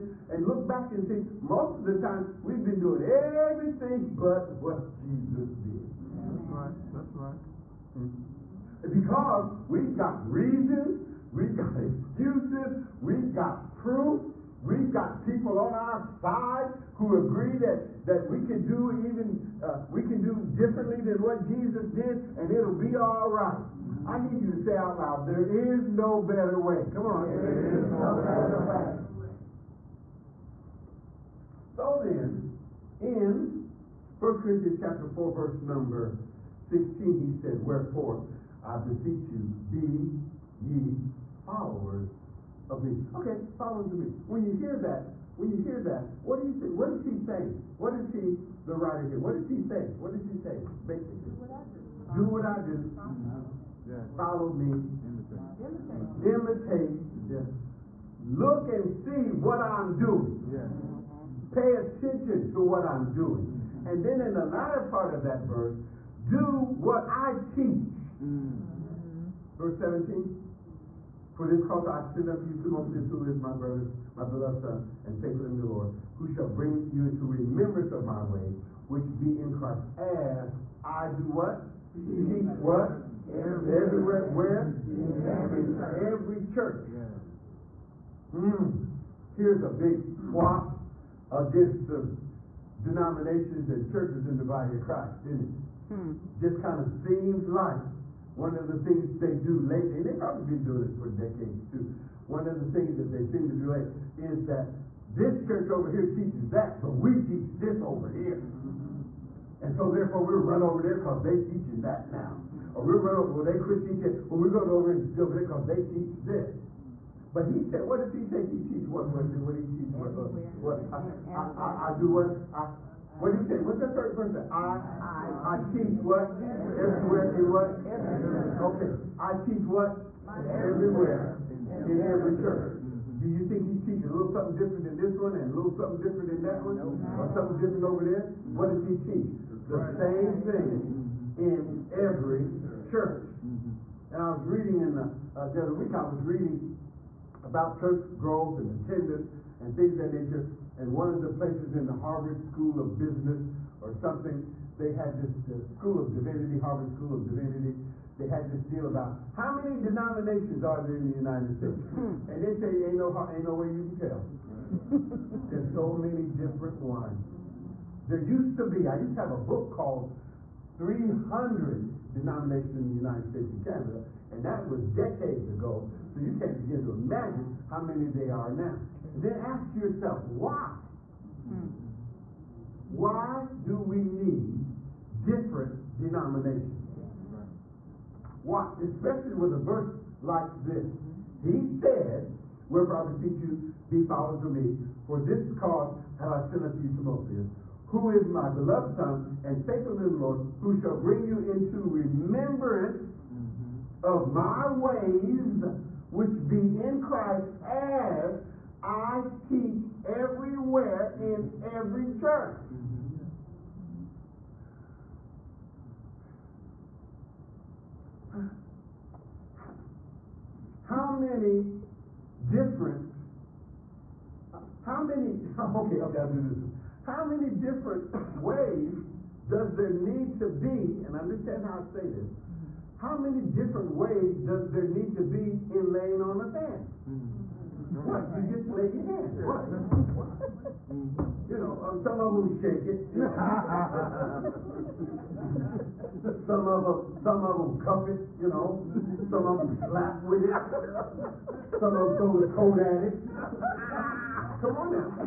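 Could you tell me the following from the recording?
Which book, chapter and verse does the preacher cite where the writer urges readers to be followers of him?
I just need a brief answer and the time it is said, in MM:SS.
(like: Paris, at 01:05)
1 Corinthians 4:16, at 00:34.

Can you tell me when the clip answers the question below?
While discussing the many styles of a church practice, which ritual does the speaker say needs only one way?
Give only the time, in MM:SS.
03:55.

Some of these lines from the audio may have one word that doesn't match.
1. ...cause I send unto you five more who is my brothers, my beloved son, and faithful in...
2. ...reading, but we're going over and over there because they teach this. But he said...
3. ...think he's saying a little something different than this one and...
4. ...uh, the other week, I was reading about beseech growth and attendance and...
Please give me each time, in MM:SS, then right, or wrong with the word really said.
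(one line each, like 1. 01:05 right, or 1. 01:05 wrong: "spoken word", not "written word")
1. 01:11 wrong: "two", not "five"
2. 01:53 wrong: "teaching", not "reading"
3. 02:13 wrong: "teaching", not "saying"
4. 02:25 wrong: "church", not "beseech".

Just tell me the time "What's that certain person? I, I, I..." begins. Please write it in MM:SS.
02:03.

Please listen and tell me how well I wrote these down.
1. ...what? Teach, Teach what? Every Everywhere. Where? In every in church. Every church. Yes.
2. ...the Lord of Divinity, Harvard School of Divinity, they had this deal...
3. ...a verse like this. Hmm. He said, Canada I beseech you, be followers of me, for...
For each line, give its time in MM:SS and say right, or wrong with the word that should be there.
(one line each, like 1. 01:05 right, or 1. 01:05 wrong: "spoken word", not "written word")
1. 01:21 right
2. 02:35 wrong: "School", not "Lord"
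3. 03:09 wrong: "Wherefore", not "Canada".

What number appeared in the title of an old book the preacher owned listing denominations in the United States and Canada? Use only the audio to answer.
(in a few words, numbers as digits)
300.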